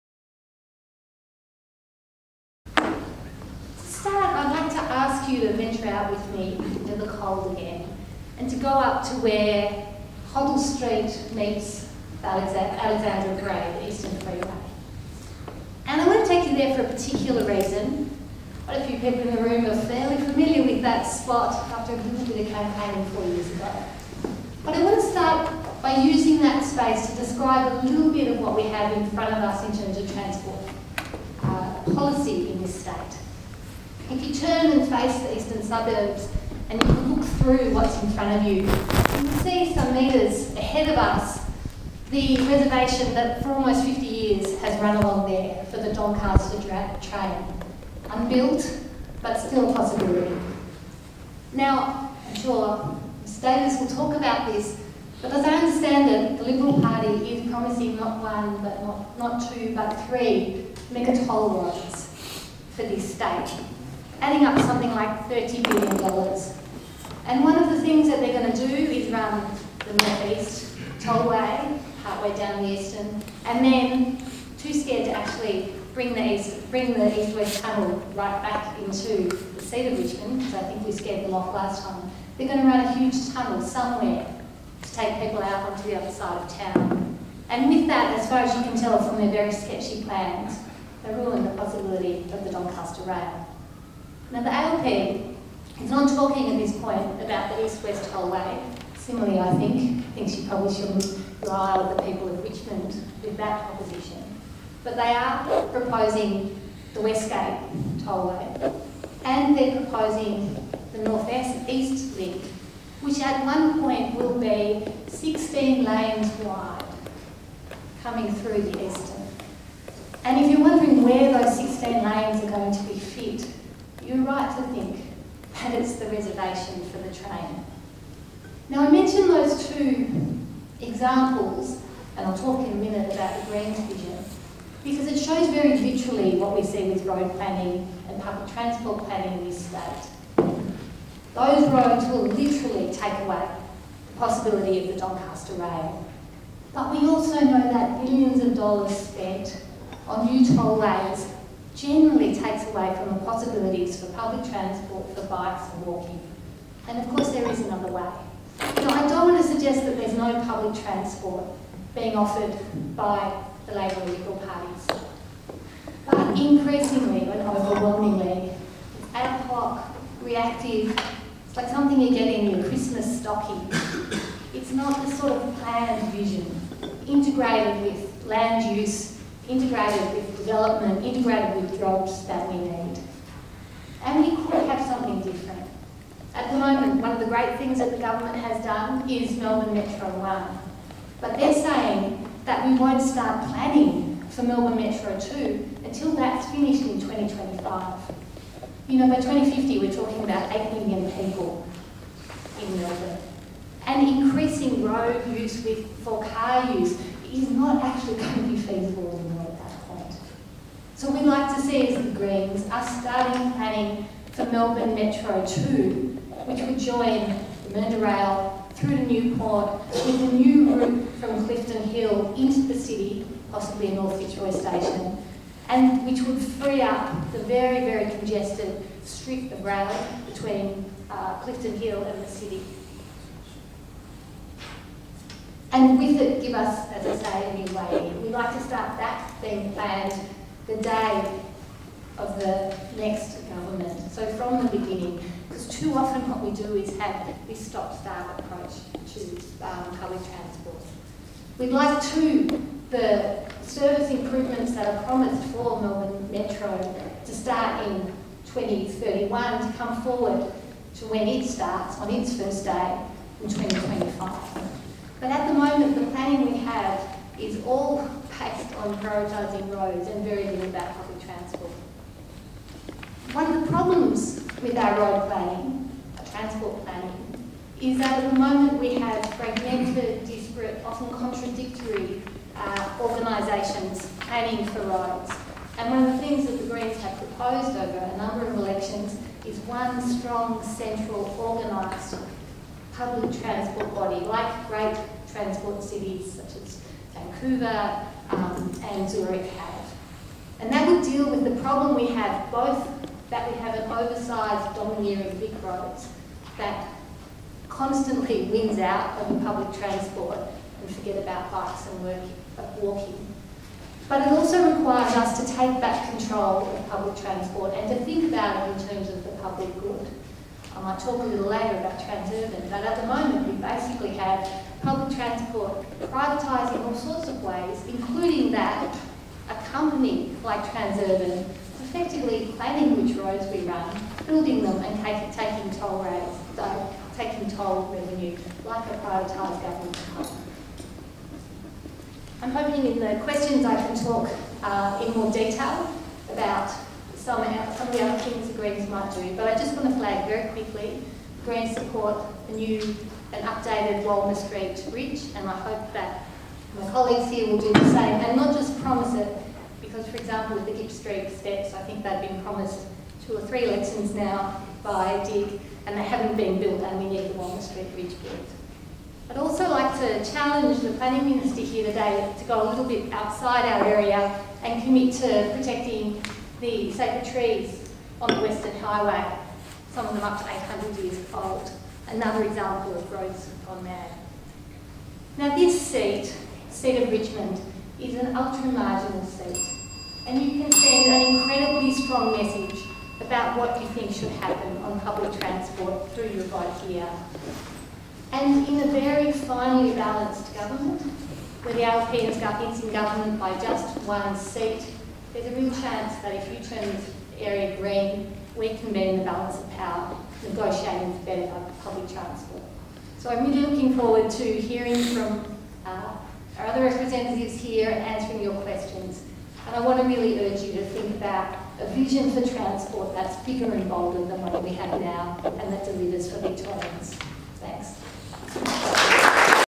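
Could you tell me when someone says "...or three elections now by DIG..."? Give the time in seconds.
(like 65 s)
363 s.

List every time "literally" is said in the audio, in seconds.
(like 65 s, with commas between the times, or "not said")
135 s, 142 s.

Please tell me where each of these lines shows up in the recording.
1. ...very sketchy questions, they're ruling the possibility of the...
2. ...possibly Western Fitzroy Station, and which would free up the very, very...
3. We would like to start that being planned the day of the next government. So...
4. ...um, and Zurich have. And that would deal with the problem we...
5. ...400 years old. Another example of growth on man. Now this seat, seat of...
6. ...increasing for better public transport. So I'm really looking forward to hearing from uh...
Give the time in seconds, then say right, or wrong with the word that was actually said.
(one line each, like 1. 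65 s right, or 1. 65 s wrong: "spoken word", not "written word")
1. 89 s wrong: "plans", not "questions"
2. 223 s wrong: "North", not "Western"
3. 238 s right
4. 298 s right
5. 380 s wrong: "800", not "400"
6. 410 s wrong: "negotiating", not "increasing".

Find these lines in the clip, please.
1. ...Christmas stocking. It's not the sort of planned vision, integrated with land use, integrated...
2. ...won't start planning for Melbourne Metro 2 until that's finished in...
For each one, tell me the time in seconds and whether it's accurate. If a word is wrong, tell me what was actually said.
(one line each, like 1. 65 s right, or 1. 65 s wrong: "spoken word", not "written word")
1. 172 s right
2. 192 s right.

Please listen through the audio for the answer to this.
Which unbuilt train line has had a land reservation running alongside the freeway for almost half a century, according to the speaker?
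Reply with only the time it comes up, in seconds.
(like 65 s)
45 s.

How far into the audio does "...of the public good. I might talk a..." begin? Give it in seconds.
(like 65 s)
319 s.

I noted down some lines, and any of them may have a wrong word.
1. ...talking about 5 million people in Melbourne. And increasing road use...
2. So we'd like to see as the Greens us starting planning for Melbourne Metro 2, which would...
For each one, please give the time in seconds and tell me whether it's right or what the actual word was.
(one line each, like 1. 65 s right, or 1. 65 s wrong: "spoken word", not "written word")
1. 199 s wrong: "8", not "5"
2. 210 s right.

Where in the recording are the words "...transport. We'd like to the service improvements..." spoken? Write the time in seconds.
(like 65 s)
250 s.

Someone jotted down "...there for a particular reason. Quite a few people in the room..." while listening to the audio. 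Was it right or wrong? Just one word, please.
right.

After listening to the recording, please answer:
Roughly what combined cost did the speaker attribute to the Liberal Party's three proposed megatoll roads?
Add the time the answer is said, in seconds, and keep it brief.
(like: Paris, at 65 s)
$30 billion, at 65 s.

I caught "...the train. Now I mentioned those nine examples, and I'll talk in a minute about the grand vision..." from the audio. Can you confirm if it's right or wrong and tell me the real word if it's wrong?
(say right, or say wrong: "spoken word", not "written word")
wrong: "two", not "nine".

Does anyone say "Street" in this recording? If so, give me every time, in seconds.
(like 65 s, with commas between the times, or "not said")
10 s, 354 s, 360 s, 367 s.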